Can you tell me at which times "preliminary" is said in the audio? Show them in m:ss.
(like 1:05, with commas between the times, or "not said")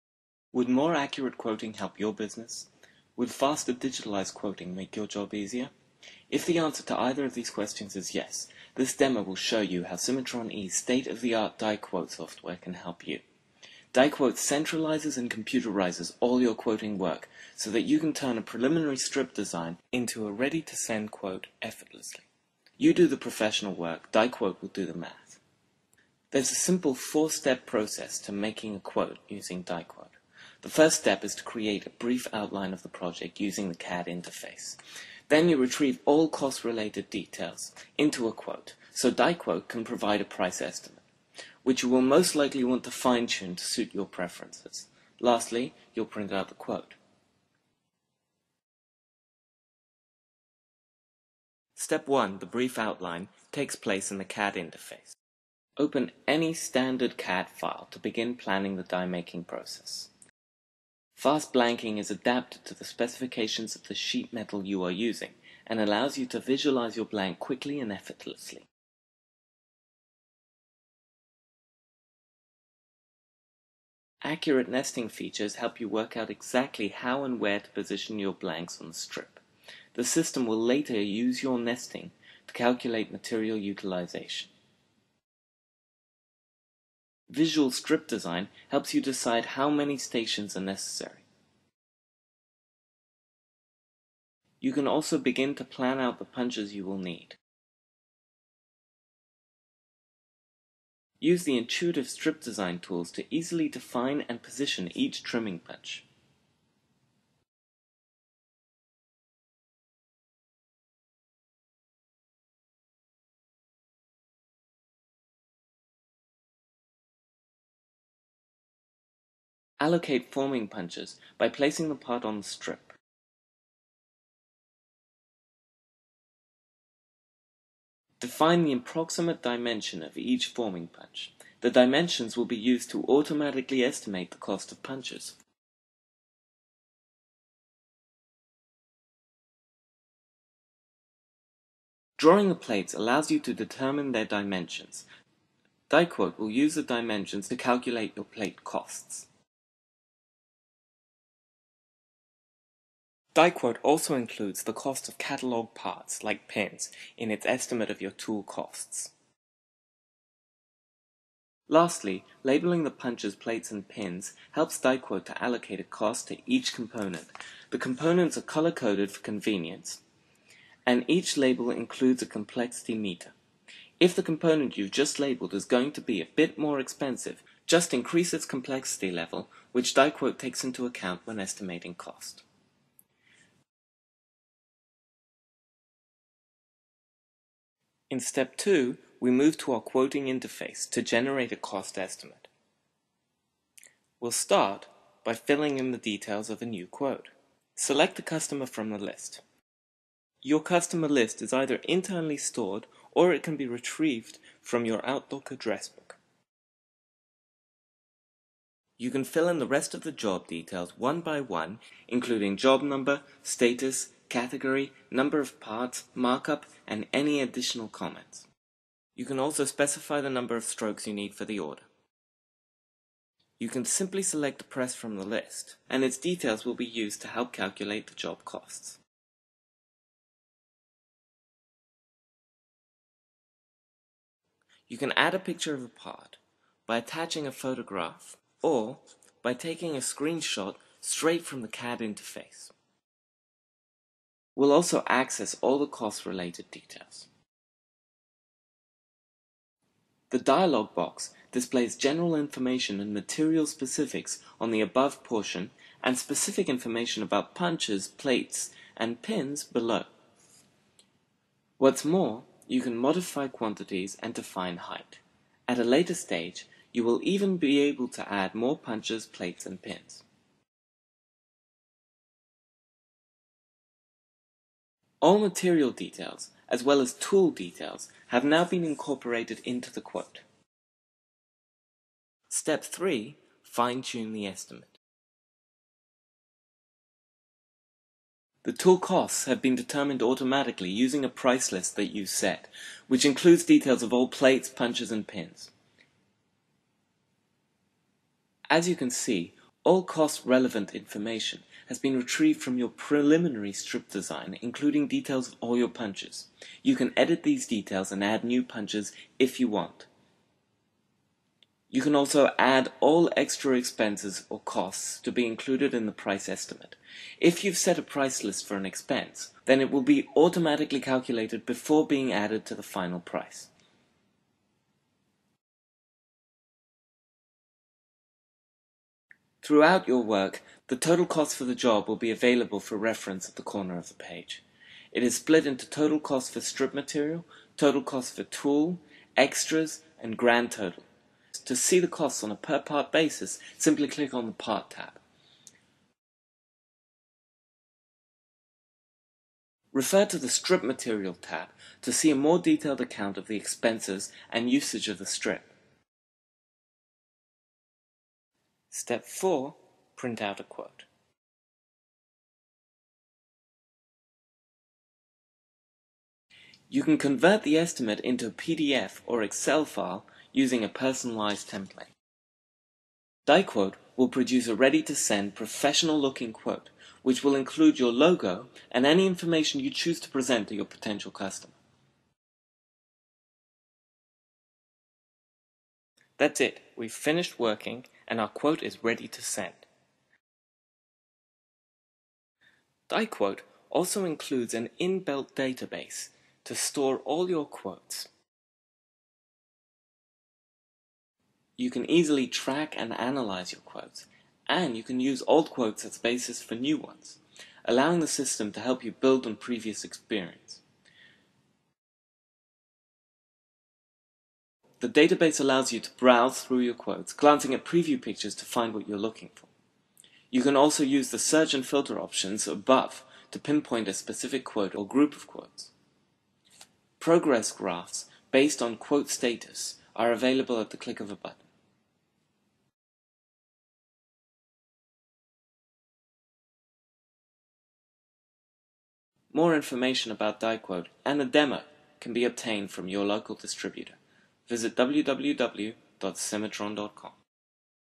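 0:18, 5:02.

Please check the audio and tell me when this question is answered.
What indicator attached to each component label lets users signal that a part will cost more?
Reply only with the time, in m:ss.
2:52.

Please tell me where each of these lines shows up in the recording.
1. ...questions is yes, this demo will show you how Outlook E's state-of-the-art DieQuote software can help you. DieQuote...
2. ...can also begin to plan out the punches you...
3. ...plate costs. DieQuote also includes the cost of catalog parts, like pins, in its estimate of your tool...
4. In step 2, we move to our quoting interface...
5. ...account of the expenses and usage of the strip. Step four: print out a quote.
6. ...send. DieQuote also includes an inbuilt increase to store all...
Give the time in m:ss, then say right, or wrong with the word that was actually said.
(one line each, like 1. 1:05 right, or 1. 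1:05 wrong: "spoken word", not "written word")
1. 0:07 wrong: "Cimatron", not "Outlook"
2. 1:34 right
3. 2:28 right
4. 3:08 right
5. 5:53 right
6. 6:29 wrong: "database", not "increase".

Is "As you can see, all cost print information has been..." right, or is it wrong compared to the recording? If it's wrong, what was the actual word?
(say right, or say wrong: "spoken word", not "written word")
wrong: "relevant", not "print".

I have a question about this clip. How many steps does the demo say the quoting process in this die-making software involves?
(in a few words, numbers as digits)
4.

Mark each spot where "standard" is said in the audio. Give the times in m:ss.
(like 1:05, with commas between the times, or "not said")
0:56.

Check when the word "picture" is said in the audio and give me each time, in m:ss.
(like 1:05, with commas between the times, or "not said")
3:55, 6:58.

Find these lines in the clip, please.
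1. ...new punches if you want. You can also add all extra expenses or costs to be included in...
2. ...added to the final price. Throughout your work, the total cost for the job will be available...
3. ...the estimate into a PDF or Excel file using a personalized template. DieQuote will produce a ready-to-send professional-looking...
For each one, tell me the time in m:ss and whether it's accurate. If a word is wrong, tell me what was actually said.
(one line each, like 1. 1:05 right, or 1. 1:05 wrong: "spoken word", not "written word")
1. 5:08 right
2. 5:22 right
3. 6:07 right.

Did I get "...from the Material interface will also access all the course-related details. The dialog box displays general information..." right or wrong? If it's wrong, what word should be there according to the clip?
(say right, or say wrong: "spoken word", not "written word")
wrong: "CAD", not "Material".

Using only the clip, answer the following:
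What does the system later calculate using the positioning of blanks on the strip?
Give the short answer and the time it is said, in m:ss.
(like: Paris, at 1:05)
Material utilization, at 1:23.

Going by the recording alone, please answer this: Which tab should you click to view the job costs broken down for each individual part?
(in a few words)
Part tab.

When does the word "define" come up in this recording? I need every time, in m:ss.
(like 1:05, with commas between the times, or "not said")
1:43, 2:08, 4:24.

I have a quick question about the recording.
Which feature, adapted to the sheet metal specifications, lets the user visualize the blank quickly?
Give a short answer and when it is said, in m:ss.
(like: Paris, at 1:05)
Fast blanking, at 1:01.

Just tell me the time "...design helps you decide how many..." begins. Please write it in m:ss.
1:28.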